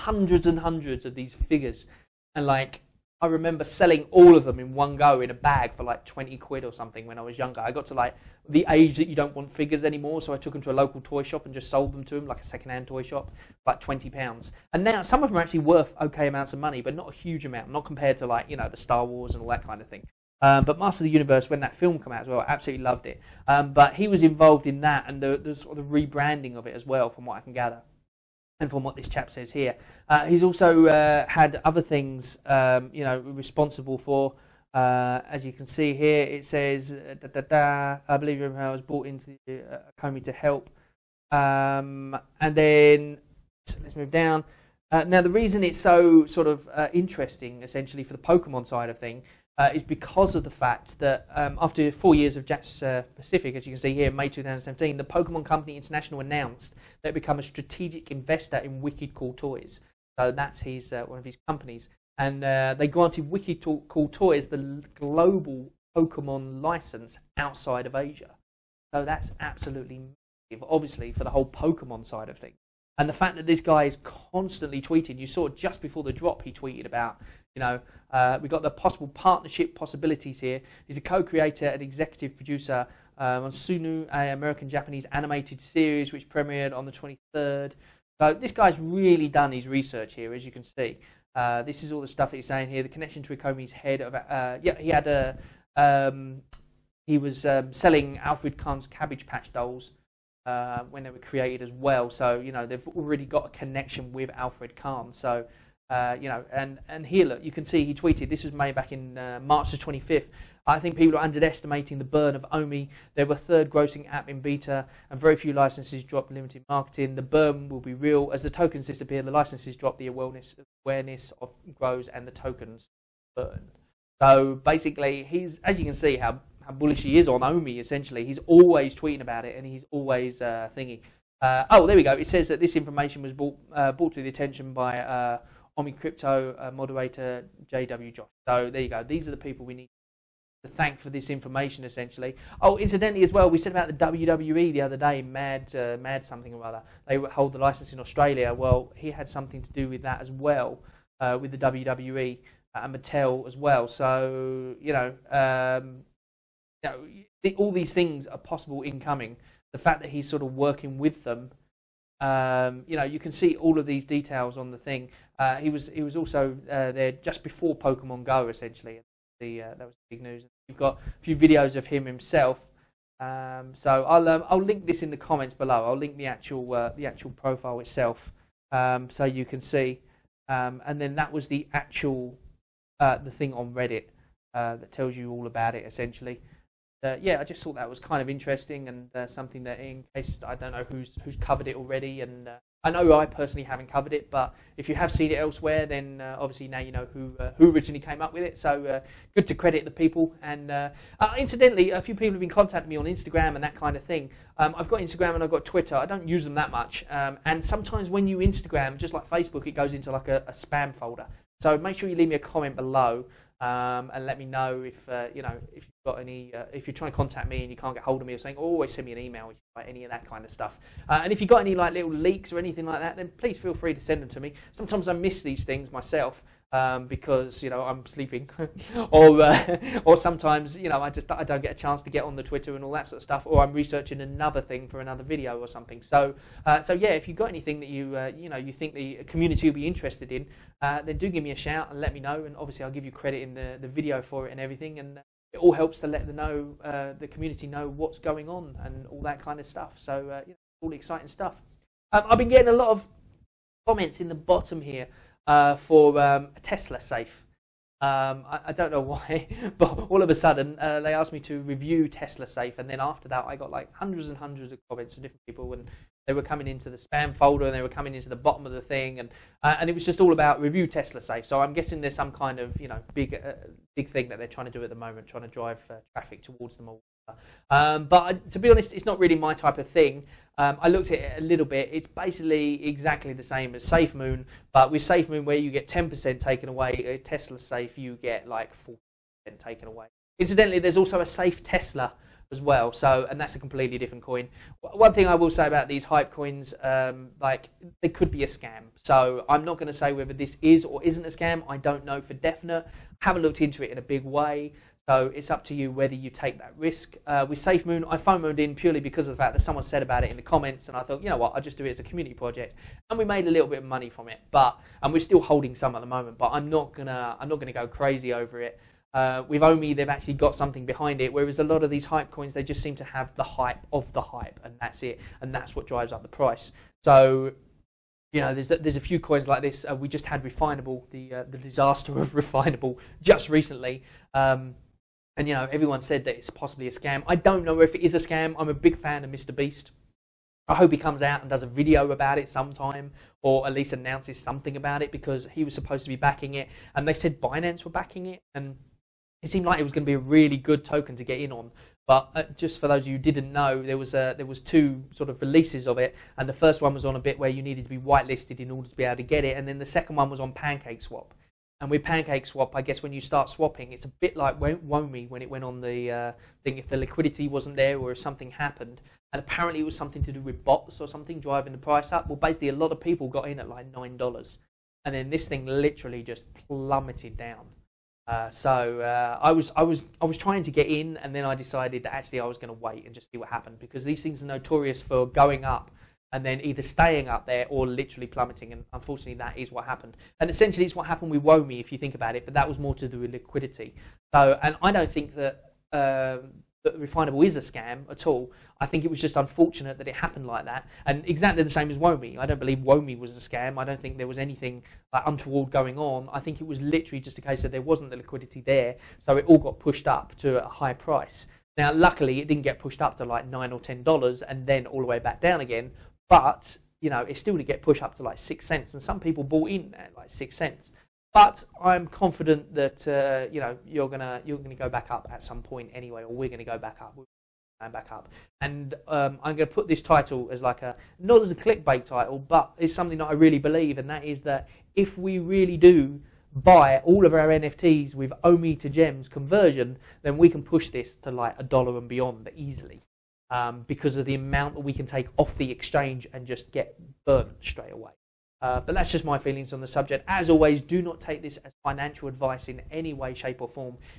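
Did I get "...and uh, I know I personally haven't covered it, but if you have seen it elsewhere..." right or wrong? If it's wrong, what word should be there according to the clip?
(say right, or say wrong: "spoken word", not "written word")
right.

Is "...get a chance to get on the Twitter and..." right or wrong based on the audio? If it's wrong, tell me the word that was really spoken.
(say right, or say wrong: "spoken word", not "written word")
right.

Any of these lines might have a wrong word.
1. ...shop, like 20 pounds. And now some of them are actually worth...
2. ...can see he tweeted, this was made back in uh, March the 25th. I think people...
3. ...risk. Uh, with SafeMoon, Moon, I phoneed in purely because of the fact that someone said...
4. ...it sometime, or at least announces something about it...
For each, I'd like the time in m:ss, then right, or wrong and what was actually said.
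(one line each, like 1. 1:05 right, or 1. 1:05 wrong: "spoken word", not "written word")
1. 0:13 right
2. 1:47 right
3. 5:06 right
4. 5:42 right.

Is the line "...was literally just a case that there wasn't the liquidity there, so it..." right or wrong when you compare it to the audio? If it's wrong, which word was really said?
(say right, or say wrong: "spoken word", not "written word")
right.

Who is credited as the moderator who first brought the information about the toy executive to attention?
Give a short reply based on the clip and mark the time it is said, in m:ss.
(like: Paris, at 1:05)
JW Josh, at 2:17.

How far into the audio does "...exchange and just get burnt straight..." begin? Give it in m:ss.
7:25.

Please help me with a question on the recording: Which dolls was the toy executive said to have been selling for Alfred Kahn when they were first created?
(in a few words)
Cabbage Patch dolls.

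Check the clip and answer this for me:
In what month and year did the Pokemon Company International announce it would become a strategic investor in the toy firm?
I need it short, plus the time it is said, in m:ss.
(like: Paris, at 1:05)
May 2017, at 0:54.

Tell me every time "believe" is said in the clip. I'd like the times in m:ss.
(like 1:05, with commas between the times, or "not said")
0:38, 6:42, 7:13.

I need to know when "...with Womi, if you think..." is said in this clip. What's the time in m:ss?
6:31.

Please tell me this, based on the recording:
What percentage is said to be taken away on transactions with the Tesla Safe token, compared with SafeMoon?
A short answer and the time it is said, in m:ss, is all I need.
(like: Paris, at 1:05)
40%, at 4:48.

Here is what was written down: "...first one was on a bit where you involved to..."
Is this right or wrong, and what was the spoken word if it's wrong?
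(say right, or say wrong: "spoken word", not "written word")
wrong: "needed", not "involved".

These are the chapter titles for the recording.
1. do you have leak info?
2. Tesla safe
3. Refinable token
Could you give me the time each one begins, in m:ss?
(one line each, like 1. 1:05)
1. 3:23
2. 4:13
3. 5:33.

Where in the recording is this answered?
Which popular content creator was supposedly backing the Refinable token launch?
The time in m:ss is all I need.
5:39.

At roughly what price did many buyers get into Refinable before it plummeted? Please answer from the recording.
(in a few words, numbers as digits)
9 dollars.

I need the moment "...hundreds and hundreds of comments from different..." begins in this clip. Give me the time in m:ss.
4:23.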